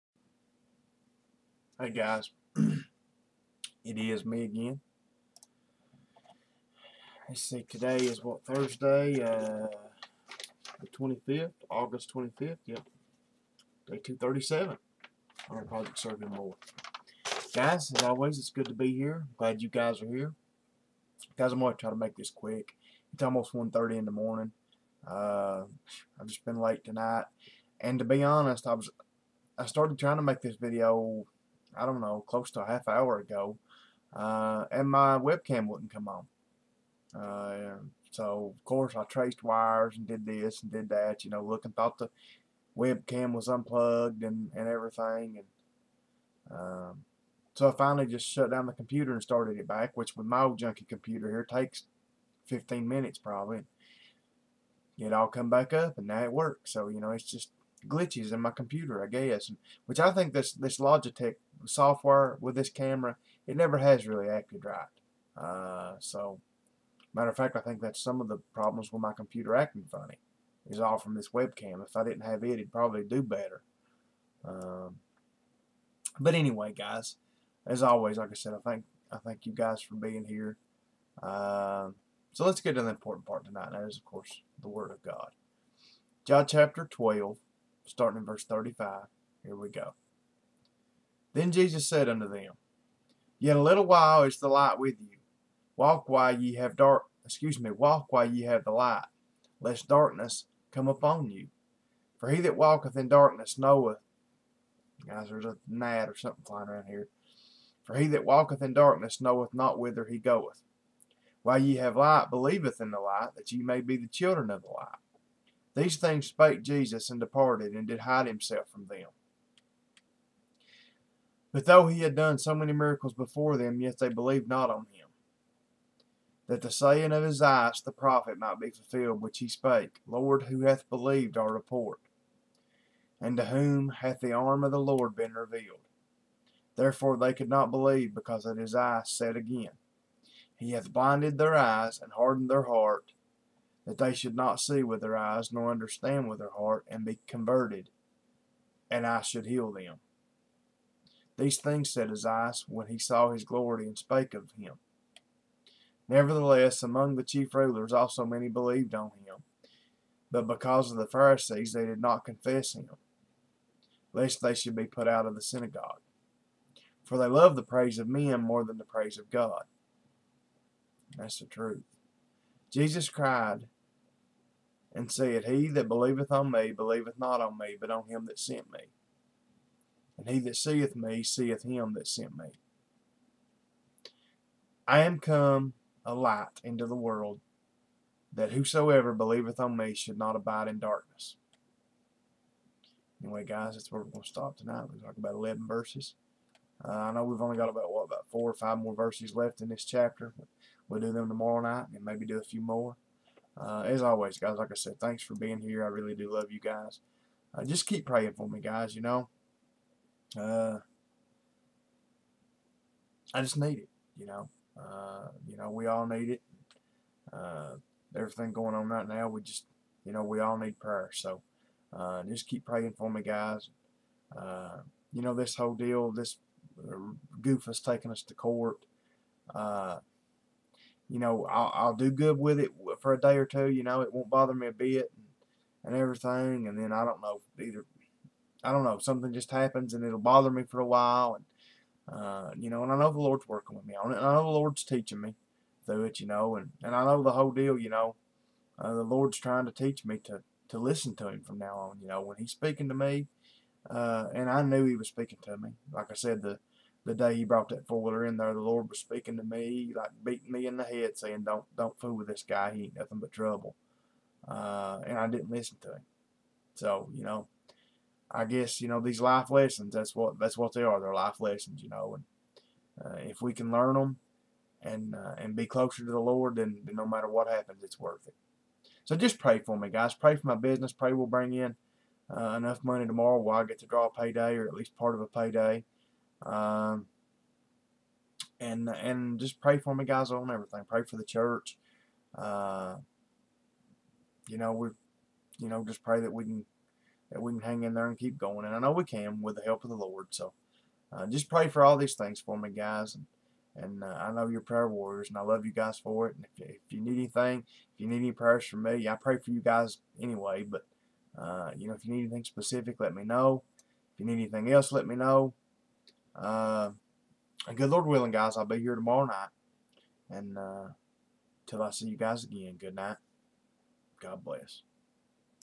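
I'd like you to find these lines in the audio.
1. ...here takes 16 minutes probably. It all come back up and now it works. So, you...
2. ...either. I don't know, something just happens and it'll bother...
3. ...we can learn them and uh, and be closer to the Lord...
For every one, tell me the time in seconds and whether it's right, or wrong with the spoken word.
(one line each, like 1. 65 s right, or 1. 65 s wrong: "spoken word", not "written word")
1. 51 s wrong: "15", not "16"
2. 237 s right
3. 273 s right.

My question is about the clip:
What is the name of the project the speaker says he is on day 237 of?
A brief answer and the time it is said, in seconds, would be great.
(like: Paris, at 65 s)
Project Serving More, at 15 s.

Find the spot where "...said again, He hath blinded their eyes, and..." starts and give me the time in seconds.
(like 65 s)
139 s.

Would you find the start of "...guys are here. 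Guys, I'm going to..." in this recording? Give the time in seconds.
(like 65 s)
19 s.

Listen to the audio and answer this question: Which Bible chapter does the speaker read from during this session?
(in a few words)
John 12.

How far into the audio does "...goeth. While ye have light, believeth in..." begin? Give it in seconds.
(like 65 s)
110 s.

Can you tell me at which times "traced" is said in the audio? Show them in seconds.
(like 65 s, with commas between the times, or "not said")
39 s.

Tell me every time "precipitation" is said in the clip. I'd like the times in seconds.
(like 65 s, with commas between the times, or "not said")
not said.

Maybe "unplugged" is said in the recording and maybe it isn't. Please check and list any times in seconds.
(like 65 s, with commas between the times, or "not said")
43 s.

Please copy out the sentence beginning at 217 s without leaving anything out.
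Uh, everything going on right now, we just, you know, we all need prayer.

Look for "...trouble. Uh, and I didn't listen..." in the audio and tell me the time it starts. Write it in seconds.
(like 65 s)
263 s.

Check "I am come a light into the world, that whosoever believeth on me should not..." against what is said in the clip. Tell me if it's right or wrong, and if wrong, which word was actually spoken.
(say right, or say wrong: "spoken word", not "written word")
right.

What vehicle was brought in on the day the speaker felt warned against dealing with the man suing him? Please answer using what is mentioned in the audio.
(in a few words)
four-wheeler.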